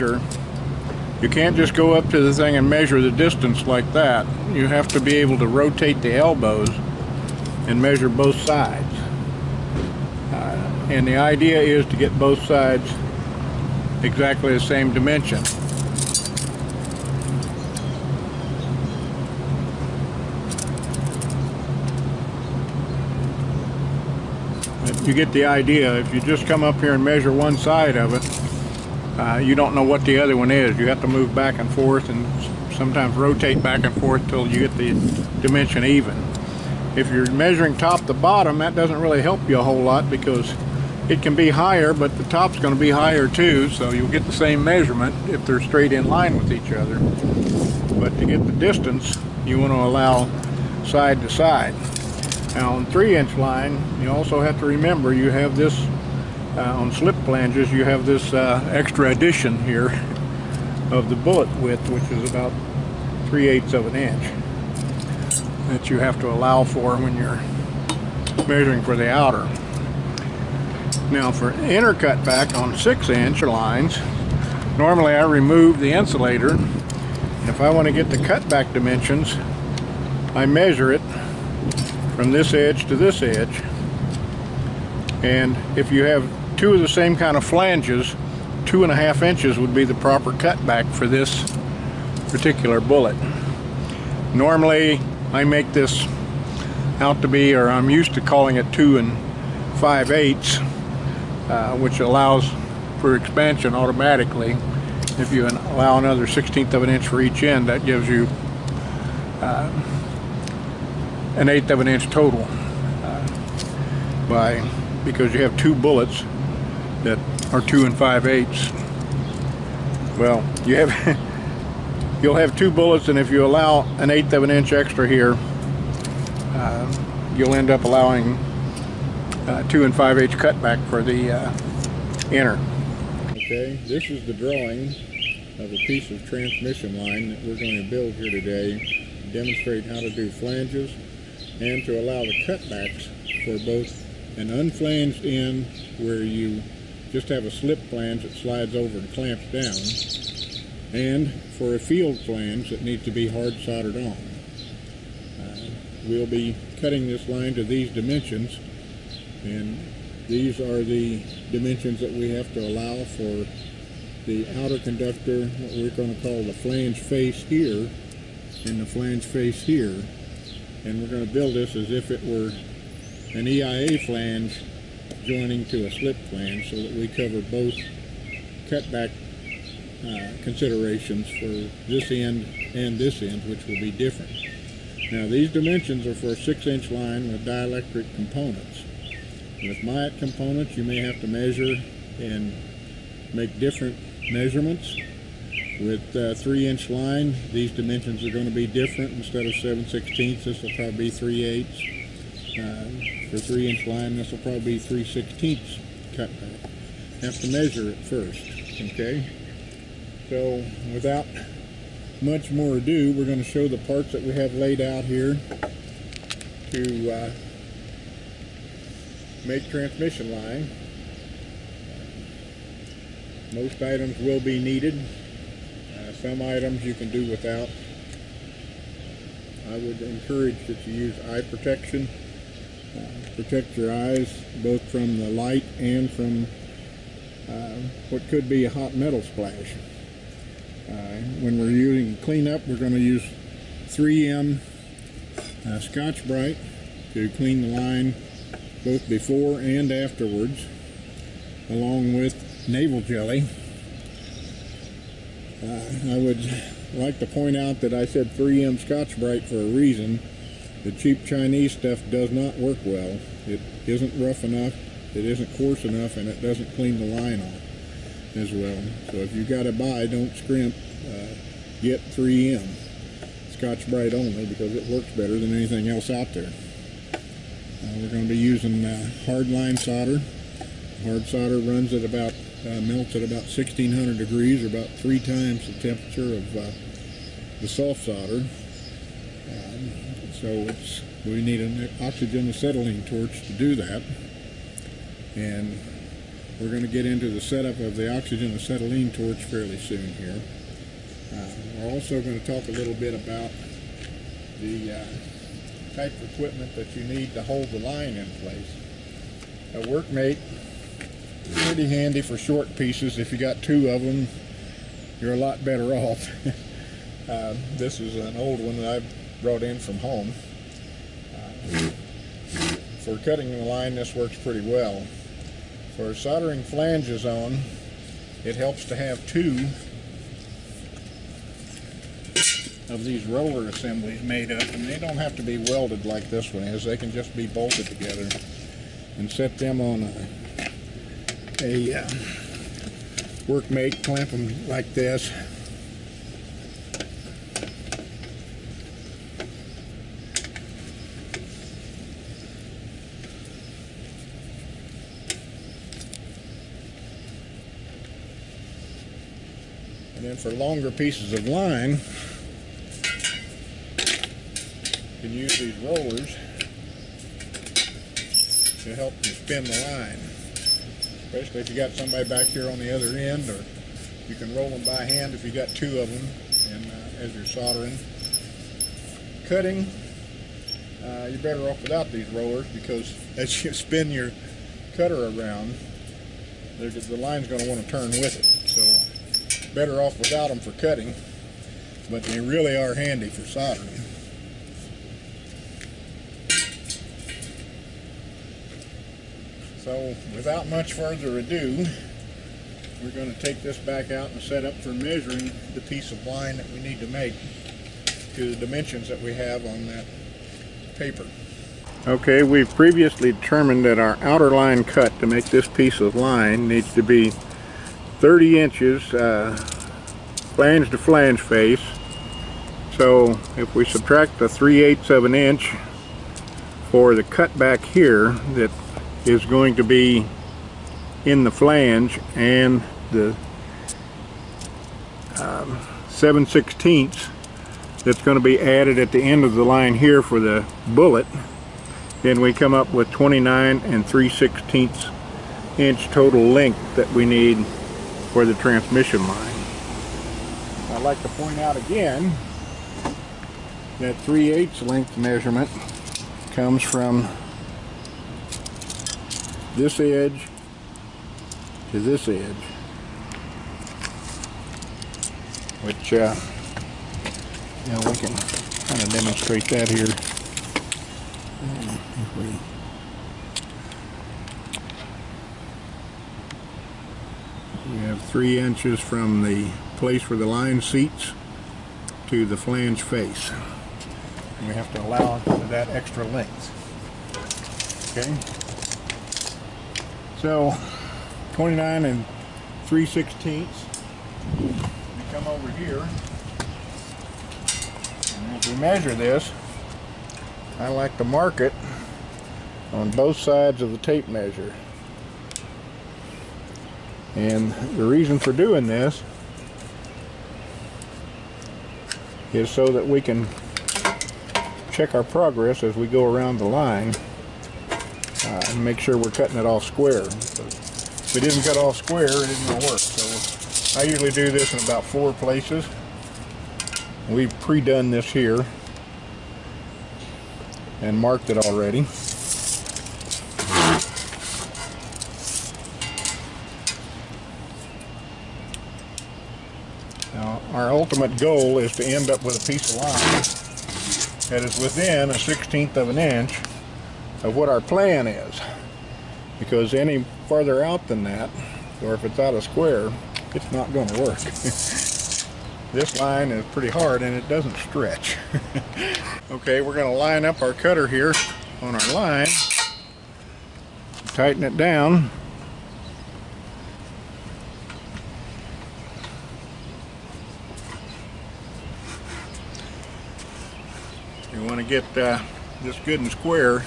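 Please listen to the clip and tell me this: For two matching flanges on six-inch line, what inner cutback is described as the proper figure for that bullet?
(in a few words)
2 1/2 inches.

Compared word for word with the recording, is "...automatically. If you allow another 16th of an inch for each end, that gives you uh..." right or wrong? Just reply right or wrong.
right.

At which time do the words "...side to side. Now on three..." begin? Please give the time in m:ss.
0:50.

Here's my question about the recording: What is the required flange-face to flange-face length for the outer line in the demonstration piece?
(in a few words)
30 inches.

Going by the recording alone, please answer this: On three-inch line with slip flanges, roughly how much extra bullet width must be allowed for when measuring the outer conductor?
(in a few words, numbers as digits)
3/8 inch.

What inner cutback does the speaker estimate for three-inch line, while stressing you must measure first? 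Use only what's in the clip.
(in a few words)
3/16.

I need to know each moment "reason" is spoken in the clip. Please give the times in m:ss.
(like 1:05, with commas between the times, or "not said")
4:19, 8:28.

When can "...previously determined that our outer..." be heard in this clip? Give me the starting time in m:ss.
6:52.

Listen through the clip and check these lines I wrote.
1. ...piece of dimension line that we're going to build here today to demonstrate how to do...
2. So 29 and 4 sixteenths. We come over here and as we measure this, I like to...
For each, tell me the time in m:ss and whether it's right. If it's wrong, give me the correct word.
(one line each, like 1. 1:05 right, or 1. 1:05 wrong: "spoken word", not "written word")
1. 2:15 wrong: "transmission", not "dimension"
2. 8:10 wrong: "3", not "4".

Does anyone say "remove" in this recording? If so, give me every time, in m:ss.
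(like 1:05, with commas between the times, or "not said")
1:15.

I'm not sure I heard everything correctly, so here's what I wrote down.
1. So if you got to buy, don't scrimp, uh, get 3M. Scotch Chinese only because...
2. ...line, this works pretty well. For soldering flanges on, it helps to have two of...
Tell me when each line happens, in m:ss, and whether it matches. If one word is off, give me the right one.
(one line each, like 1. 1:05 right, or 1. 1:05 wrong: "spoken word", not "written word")
1. 4:29 wrong: "Brite", not "Chinese"
2. 5:23 right.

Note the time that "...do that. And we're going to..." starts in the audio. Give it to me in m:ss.
4:53.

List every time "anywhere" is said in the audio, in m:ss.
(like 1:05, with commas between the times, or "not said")
not said.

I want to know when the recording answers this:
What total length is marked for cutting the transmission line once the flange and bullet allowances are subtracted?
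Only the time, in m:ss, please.
7:23.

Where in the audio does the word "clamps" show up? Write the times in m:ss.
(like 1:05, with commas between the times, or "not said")
2:29, 5:44.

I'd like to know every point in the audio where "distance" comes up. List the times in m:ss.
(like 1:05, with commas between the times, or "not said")
0:03, 0:48.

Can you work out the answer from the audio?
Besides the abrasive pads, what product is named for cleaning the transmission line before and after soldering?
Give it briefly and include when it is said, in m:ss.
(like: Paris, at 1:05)
Naval Jelly, at 4:12.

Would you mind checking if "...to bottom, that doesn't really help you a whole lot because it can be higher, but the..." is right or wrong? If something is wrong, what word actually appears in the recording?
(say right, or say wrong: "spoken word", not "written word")
right.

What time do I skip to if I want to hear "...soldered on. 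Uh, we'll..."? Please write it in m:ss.
2:33.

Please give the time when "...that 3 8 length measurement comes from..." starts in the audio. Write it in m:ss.
7:33.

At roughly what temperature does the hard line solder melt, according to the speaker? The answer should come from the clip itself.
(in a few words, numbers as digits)
1600 degrees.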